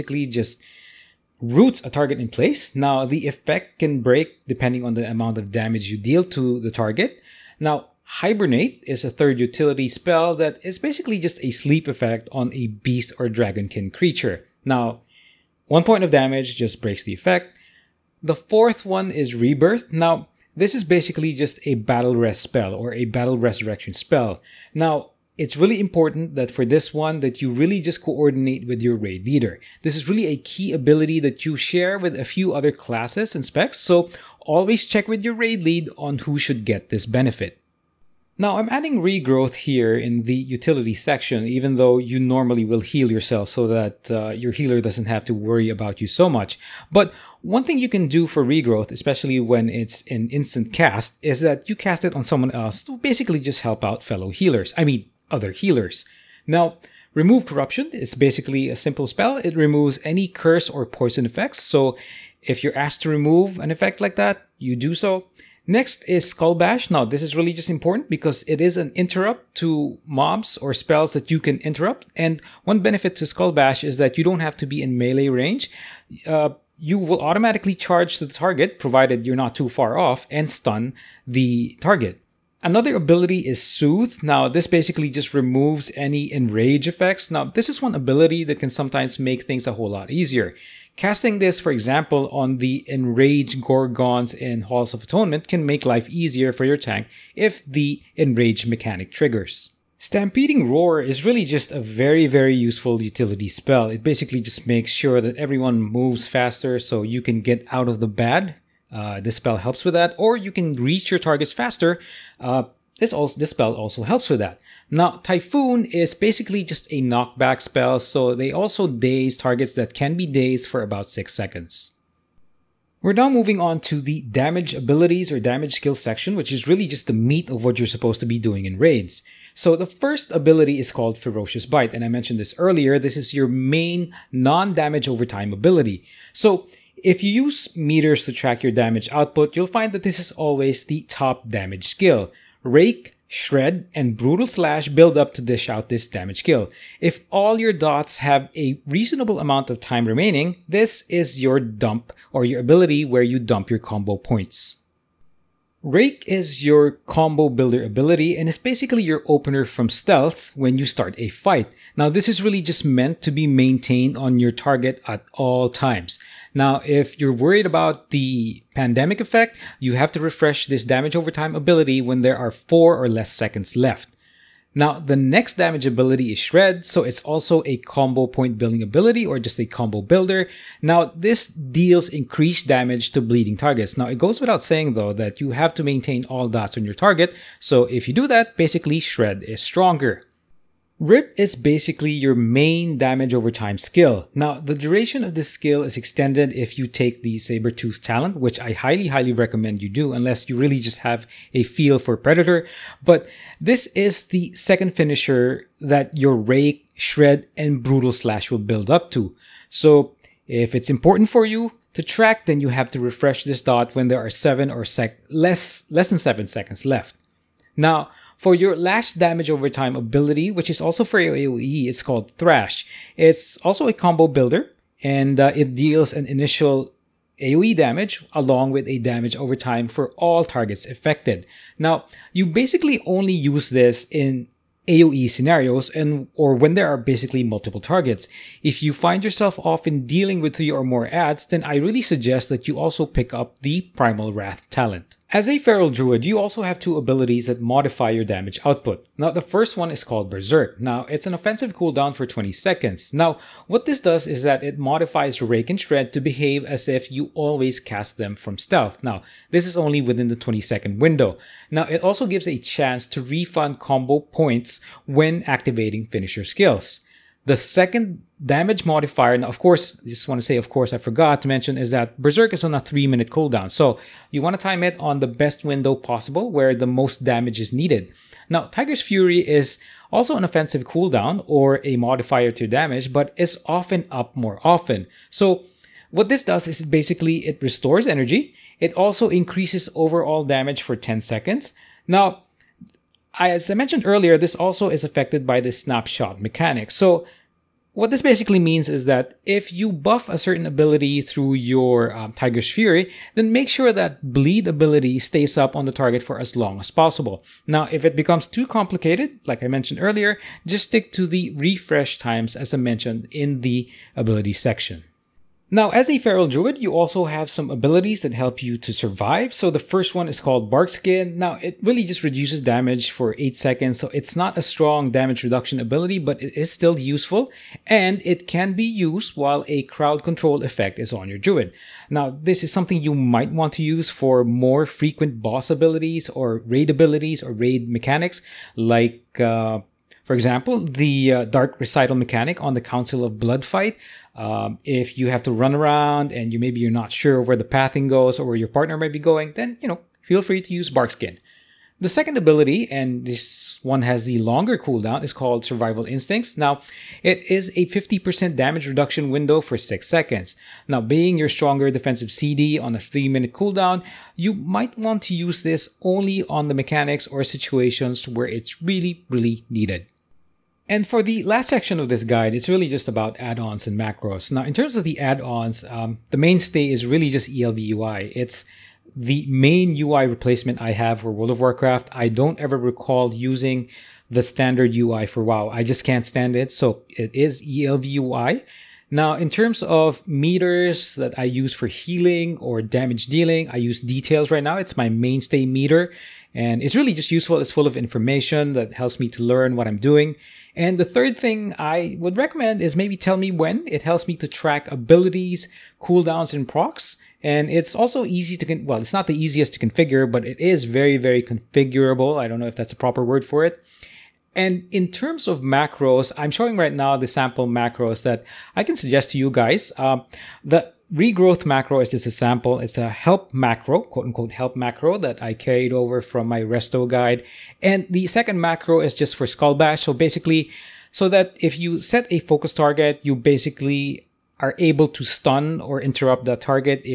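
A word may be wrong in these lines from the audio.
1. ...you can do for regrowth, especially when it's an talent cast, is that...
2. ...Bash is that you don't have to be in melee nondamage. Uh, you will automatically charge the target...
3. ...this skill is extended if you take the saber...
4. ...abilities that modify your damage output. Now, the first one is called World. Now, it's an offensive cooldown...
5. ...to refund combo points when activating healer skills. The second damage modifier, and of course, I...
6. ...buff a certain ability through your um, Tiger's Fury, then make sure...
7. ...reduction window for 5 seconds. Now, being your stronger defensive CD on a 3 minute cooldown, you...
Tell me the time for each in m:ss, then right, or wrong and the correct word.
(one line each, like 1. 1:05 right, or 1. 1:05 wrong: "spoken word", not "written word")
1. 0:47 wrong: "instant", not "talent"
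2. 1:13 wrong: "range", not "nondamage"
3. 3:15 right
4. 4:06 wrong: "Berserk", not "World"
5. 4:23 wrong: "finisher", not "healer"
6. 4:59 right
7. 5:58 wrong: "6", not "5".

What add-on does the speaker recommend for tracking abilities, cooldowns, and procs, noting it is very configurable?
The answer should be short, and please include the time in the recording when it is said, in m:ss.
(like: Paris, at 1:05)
TellMeWhen, at 6:43.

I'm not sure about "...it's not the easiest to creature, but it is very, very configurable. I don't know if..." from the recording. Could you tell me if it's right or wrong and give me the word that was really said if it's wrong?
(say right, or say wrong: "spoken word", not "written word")
wrong: "configure", not "creature".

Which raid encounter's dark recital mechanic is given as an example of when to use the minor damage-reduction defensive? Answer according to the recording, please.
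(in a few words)
Council of Blood.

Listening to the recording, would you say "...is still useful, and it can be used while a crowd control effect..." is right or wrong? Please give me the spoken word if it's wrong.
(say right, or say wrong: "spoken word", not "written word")
right.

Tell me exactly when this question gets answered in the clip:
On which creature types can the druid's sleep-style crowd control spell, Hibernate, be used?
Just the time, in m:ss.
0:12.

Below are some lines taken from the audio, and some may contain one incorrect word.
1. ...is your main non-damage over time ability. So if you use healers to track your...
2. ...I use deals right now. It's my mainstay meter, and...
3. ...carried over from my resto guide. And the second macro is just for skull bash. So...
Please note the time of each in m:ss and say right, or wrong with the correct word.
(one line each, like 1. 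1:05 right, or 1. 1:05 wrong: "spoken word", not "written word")
1. 2:13 wrong: "meters", not "healers"
2. 6:33 wrong: "details", not "deals"
3. 7:05 right.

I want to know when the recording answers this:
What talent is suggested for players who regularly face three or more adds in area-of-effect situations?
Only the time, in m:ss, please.
4:03.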